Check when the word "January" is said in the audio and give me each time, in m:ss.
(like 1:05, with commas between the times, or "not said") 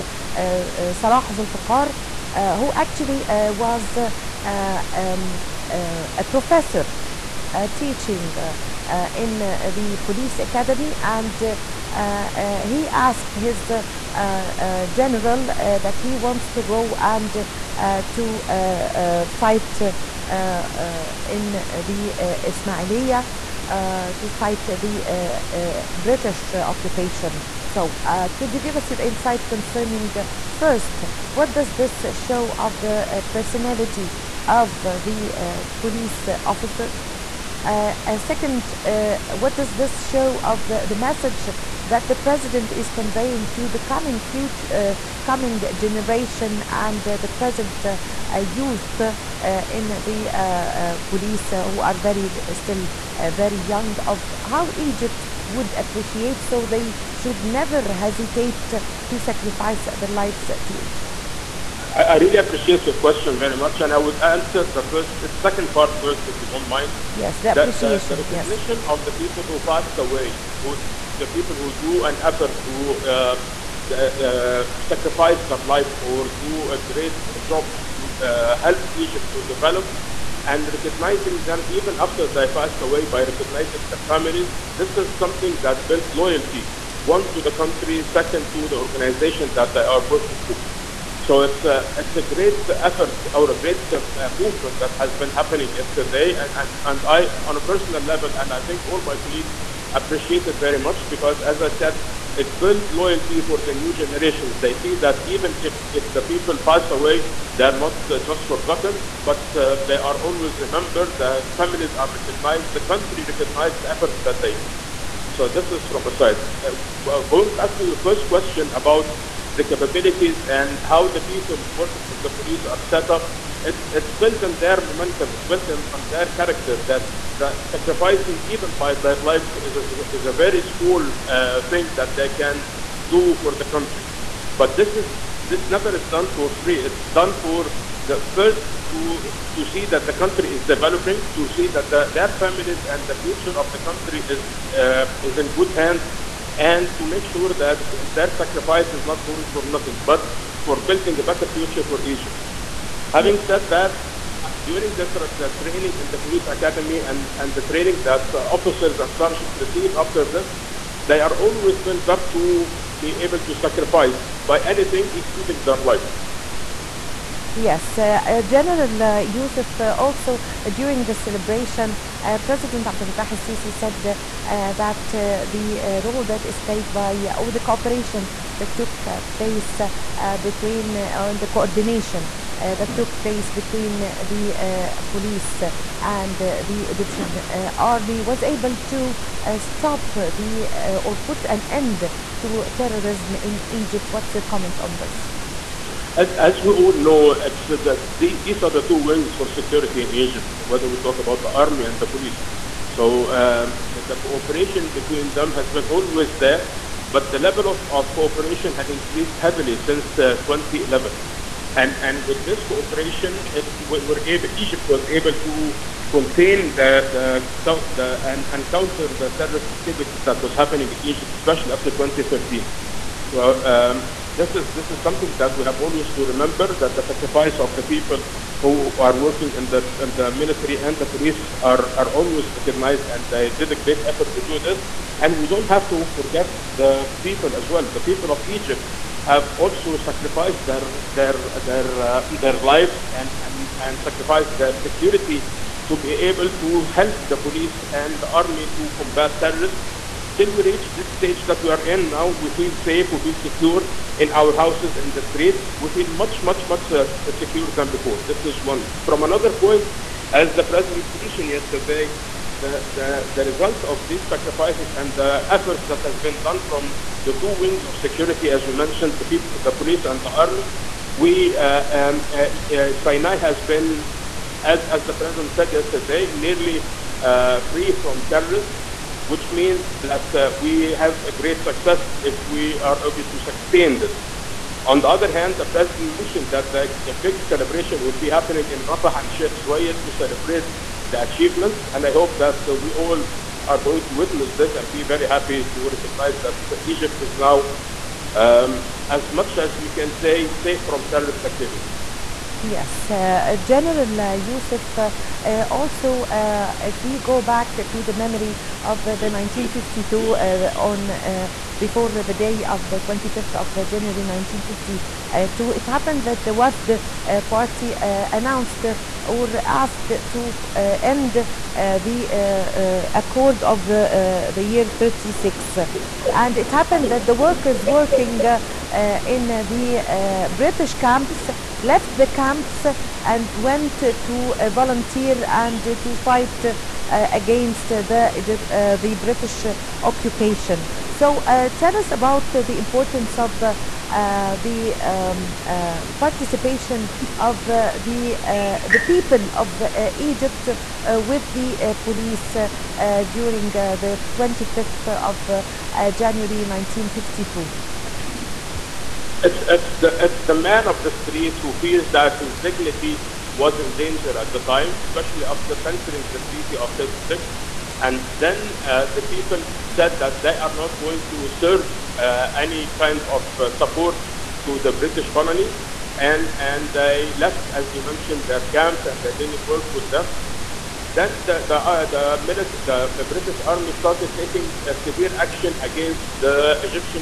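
5:13, 5:56.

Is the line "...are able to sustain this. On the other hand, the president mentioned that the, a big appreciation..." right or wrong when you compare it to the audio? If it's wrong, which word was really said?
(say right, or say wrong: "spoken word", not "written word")
wrong: "celebration", not "appreciation".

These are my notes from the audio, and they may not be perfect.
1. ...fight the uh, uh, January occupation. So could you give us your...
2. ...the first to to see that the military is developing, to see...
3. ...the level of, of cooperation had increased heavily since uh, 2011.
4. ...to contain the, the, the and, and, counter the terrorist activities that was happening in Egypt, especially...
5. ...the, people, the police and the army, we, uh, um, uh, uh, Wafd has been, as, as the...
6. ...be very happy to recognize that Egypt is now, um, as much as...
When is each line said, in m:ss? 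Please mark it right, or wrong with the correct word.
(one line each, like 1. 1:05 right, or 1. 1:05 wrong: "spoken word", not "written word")
1. 0:24 wrong: "British", not "January"
2. 2:18 wrong: "country", not "military"
3. 3:27 right
4. 3:35 right
5. 4:29 wrong: "Sinai", not "Wafd"
6. 4:54 right.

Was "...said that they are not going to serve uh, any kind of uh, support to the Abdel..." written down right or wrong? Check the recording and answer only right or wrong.
wrong.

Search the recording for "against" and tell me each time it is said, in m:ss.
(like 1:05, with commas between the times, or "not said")
5:37, 6:25.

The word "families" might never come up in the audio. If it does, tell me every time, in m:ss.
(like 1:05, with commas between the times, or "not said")
1:24, 1:51, 2:22.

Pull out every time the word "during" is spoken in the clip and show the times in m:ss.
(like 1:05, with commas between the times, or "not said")
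2:34, 2:50, 5:53.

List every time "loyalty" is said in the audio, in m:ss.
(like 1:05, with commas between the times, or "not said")
1:26, 1:42.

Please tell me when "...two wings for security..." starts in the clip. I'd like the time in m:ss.
3:18.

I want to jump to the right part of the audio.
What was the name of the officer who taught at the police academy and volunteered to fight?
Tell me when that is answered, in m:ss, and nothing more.
0:01.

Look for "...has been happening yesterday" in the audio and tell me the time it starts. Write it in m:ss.
1:34.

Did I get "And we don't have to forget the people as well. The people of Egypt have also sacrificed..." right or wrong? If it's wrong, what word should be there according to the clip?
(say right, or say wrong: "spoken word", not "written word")
right.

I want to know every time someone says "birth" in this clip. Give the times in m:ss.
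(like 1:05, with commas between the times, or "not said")
not said.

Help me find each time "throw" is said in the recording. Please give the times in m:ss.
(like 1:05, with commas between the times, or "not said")
not said.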